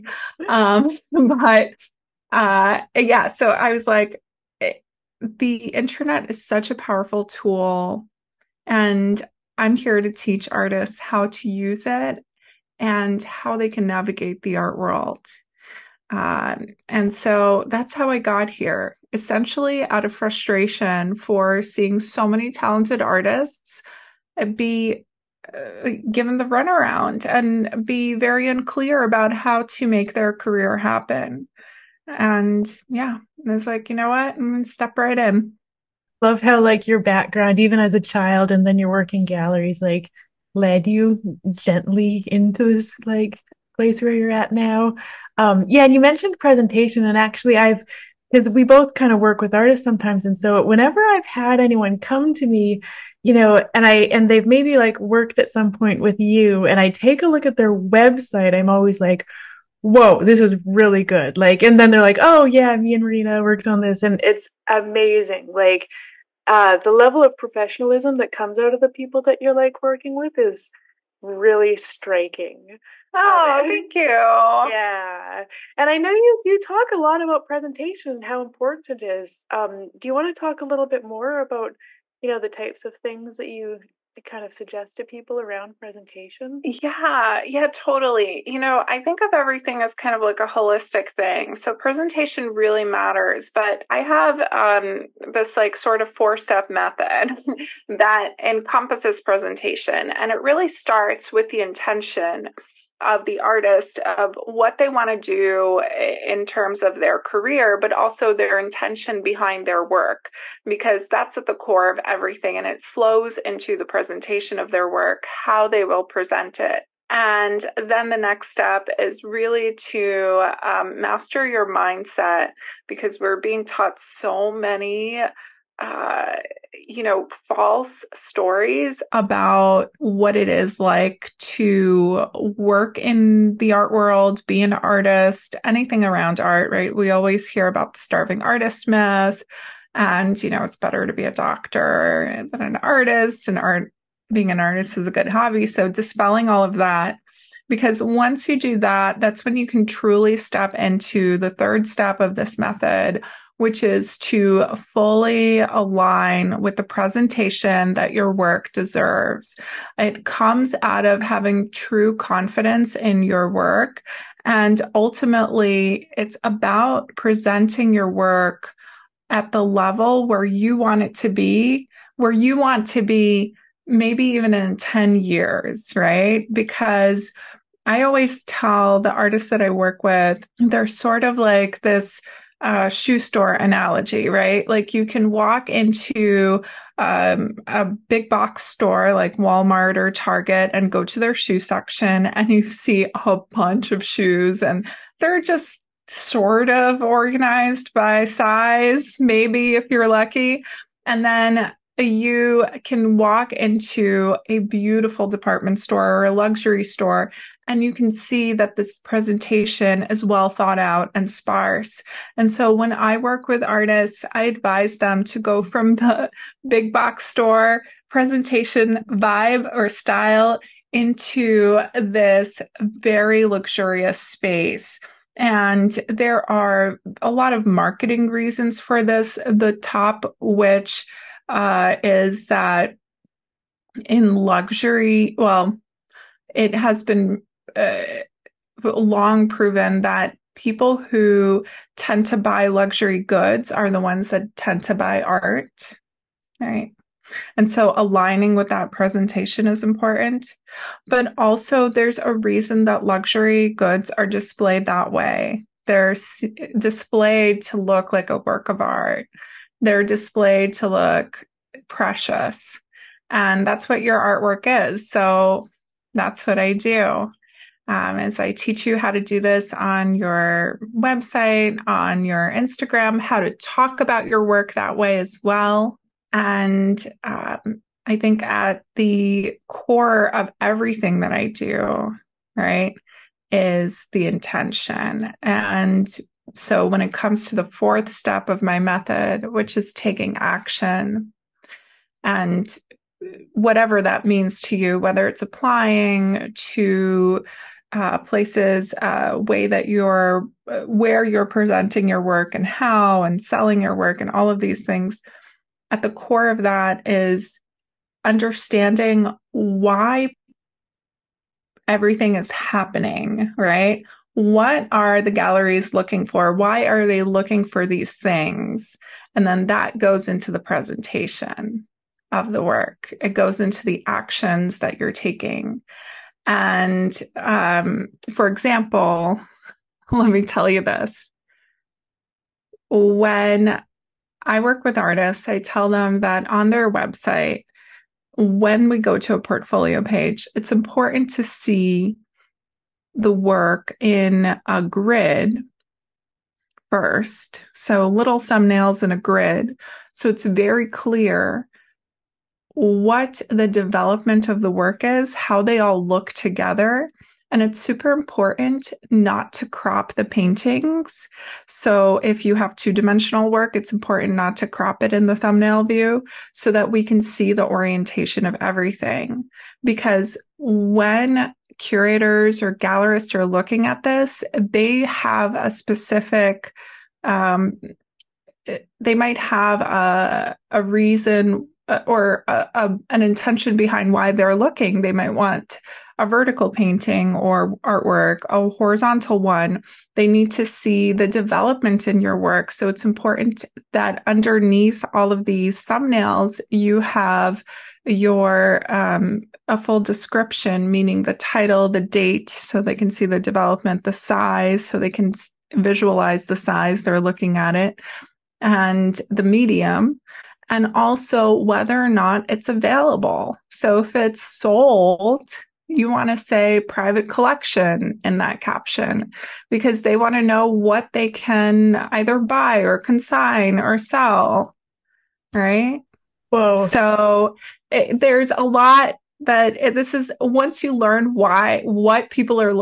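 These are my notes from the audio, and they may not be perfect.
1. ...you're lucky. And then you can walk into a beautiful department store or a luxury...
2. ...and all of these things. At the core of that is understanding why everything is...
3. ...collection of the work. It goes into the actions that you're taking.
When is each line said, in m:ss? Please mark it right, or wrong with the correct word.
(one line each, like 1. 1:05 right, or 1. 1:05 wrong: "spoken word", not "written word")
1. 3:19 right
2. 5:04 right
3. 5:20 wrong: "presentation", not "collection".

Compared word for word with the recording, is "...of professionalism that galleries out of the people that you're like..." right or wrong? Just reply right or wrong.
wrong.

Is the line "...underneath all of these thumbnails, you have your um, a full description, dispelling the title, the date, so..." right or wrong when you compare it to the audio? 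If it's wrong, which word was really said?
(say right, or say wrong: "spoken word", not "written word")
wrong: "meaning", not "dispelling".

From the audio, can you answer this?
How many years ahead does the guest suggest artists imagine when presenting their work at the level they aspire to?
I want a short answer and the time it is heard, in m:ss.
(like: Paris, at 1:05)
10, at 2:54.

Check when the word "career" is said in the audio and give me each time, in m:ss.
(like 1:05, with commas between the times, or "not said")
0:30, 1:47.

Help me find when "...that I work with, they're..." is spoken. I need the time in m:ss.
2:59.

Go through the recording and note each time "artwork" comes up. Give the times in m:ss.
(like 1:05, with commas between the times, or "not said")
4:24, 6:27.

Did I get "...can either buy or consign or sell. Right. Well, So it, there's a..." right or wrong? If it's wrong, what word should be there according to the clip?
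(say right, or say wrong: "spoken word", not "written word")
right.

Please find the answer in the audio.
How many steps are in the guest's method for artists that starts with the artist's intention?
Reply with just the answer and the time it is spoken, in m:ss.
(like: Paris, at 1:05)
4, at 1:36.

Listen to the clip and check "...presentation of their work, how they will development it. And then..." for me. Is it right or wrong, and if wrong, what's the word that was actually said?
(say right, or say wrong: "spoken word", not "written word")
wrong: "present", not "development".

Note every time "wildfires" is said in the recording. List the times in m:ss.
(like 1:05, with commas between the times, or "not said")
not said.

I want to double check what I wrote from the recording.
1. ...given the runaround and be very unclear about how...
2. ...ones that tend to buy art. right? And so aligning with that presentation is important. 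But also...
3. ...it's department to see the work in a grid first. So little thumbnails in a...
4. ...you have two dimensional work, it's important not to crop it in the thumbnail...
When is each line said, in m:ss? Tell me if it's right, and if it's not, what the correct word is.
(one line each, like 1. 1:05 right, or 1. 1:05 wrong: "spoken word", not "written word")
1. 0:26 right
2. 4:04 right
3. 5:40 wrong: "important", not "department"
4. 6:02 right.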